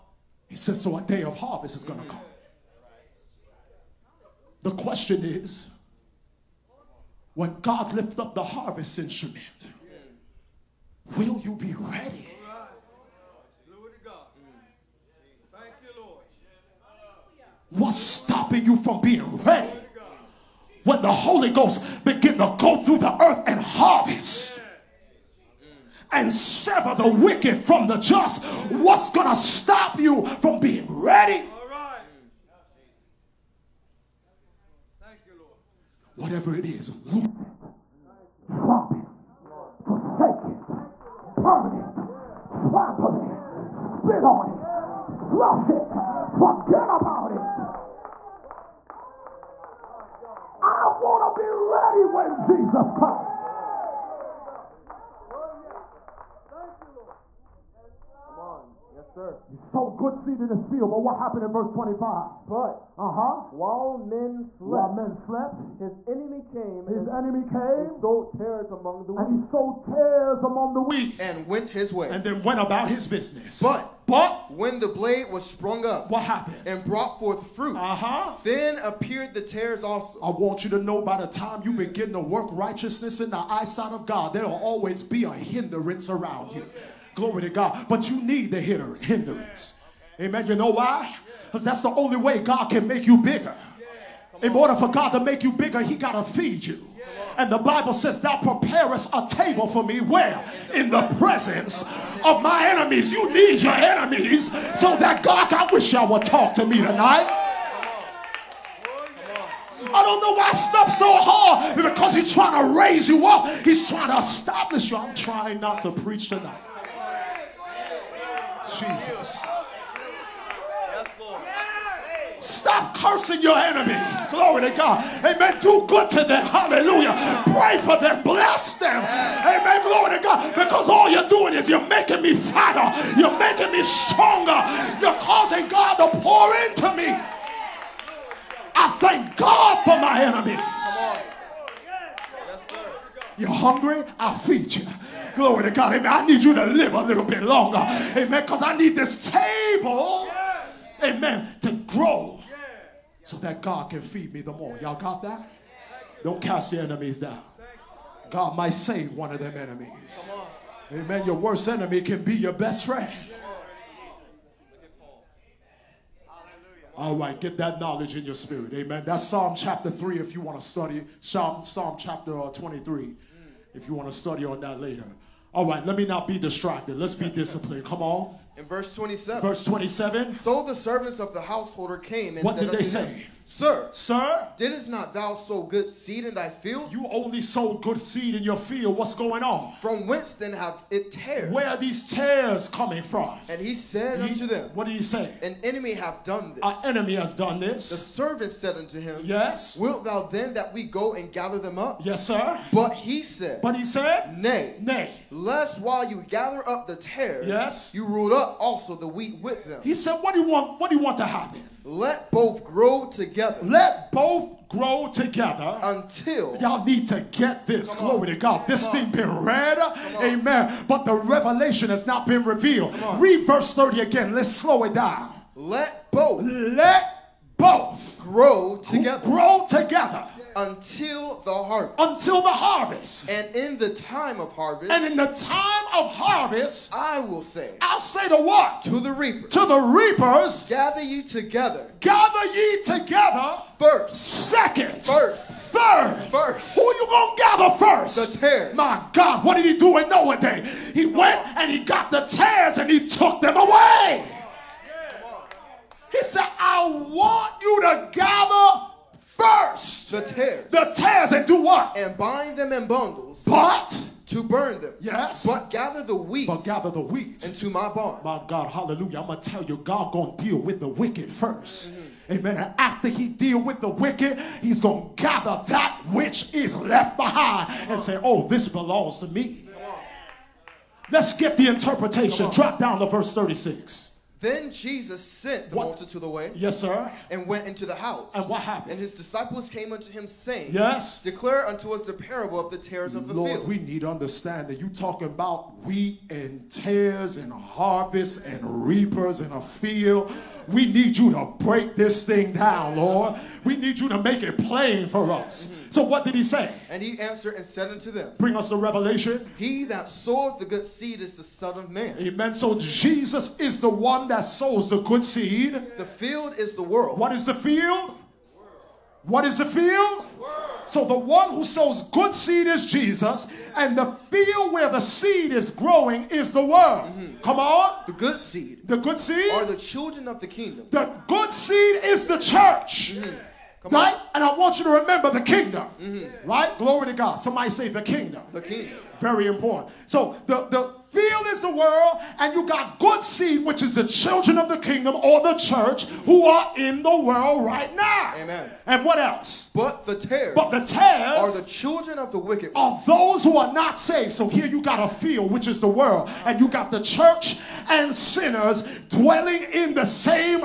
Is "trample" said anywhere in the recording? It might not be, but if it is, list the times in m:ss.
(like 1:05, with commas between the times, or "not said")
0:42.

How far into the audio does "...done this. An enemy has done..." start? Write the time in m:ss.
3:16.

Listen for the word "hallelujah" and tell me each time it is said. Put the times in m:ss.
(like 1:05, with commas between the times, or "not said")
2:06, 4:28.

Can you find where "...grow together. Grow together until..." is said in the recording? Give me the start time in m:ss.
3:48.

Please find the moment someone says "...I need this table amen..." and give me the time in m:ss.
2:28.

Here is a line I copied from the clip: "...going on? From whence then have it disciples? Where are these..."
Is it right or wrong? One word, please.
wrong.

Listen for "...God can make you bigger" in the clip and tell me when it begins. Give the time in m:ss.
1:32.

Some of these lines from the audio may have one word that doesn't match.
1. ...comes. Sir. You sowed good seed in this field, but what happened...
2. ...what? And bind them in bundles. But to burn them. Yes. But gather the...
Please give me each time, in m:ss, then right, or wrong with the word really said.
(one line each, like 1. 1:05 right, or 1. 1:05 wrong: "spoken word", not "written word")
1. 0:52 right
2. 4:21 right.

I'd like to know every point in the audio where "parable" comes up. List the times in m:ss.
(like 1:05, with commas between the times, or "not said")
4:52.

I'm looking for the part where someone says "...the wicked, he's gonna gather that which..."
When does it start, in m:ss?
4:33.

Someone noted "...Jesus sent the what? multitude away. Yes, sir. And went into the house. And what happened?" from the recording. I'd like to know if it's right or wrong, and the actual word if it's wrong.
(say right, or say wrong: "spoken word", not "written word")
right.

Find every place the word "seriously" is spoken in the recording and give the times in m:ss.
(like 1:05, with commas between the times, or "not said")
not said.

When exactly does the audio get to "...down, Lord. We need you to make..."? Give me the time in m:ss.
5:02.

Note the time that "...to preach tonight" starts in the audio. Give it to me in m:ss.
1:55.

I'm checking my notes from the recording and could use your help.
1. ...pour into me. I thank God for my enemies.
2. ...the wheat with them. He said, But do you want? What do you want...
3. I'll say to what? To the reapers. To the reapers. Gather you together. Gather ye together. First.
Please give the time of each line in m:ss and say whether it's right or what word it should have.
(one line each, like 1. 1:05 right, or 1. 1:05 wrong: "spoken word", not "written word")
1. 2:16 right
2. 3:28 wrong: "What", not "But"
3. 3:57 right.